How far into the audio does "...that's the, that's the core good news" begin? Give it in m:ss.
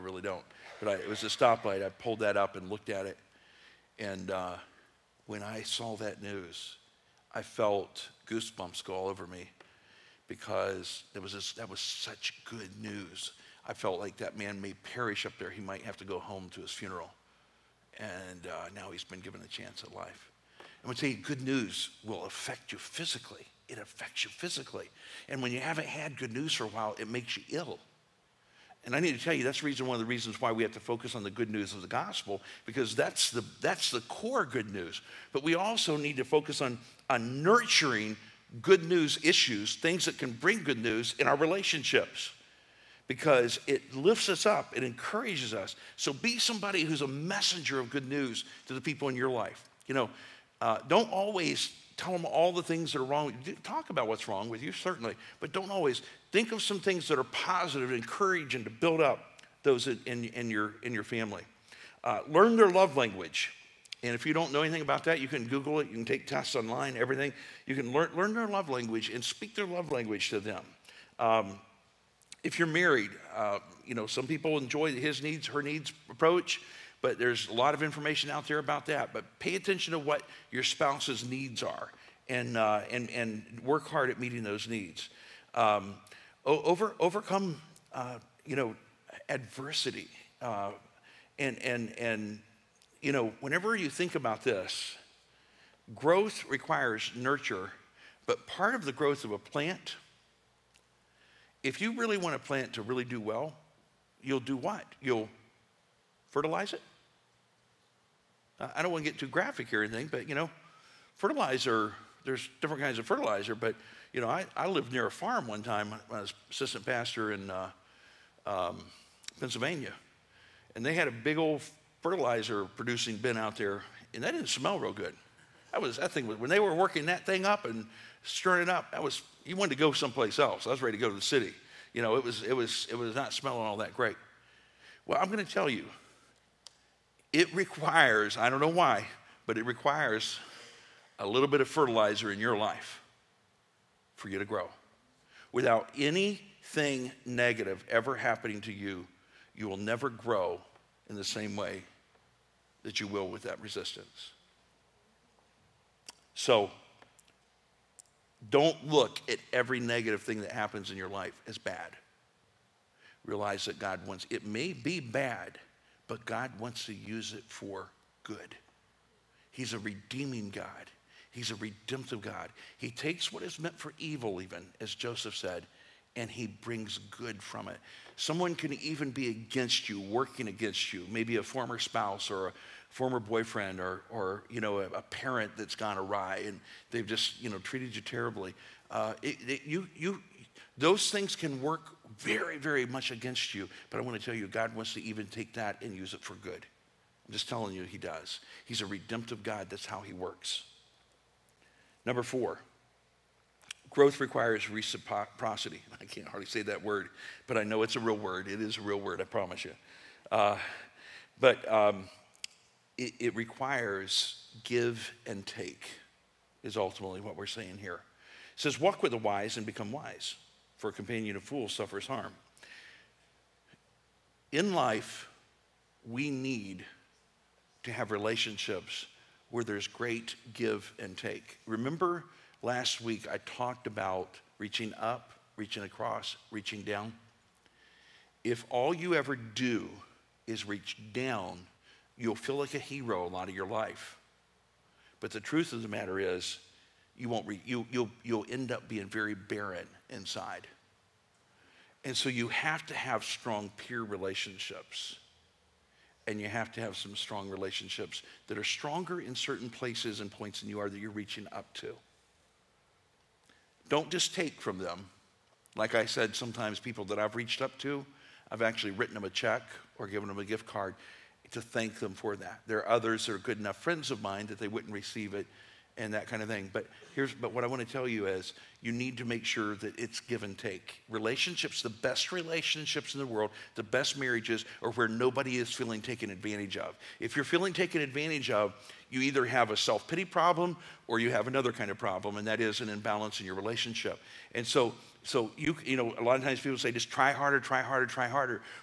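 0:32.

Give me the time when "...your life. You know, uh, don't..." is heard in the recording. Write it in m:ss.
0:49.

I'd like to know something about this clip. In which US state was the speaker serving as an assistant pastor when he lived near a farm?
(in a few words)
Pennsylvania.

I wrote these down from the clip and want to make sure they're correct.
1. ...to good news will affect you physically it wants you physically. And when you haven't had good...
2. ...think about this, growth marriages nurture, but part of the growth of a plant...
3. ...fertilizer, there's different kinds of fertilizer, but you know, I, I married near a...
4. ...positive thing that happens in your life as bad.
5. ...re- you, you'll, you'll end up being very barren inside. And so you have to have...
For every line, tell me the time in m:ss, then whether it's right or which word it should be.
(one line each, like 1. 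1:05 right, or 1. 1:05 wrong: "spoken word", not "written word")
1. 0:20 wrong: "affects", not "wants"
2. 1:33 wrong: "requires", not "marriages"
3. 1:51 wrong: "lived", not "married"
4. 2:39 wrong: "negative", not "positive"
5. 4:07 right.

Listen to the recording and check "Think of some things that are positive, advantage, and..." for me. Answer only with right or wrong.
wrong.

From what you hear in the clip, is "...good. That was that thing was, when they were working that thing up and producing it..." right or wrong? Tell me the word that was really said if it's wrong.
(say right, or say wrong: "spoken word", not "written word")
wrong: "stirring", not "producing".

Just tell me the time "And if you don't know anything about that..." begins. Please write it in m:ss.
1:04.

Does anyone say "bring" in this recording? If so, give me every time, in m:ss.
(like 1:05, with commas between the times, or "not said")
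0:40, 2:56.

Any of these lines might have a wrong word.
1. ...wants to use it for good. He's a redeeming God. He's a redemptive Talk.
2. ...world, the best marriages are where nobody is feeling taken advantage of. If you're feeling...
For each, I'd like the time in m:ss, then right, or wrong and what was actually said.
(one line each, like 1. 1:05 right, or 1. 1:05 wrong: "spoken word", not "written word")
1. 2:46 wrong: "God", not "Talk"
2. 4:43 right.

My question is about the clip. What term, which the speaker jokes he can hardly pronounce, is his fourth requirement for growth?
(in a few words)
reciprocity.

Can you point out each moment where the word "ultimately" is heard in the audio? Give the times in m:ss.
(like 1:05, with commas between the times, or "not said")
3:36.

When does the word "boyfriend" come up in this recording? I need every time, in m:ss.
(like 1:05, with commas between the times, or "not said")
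3:03.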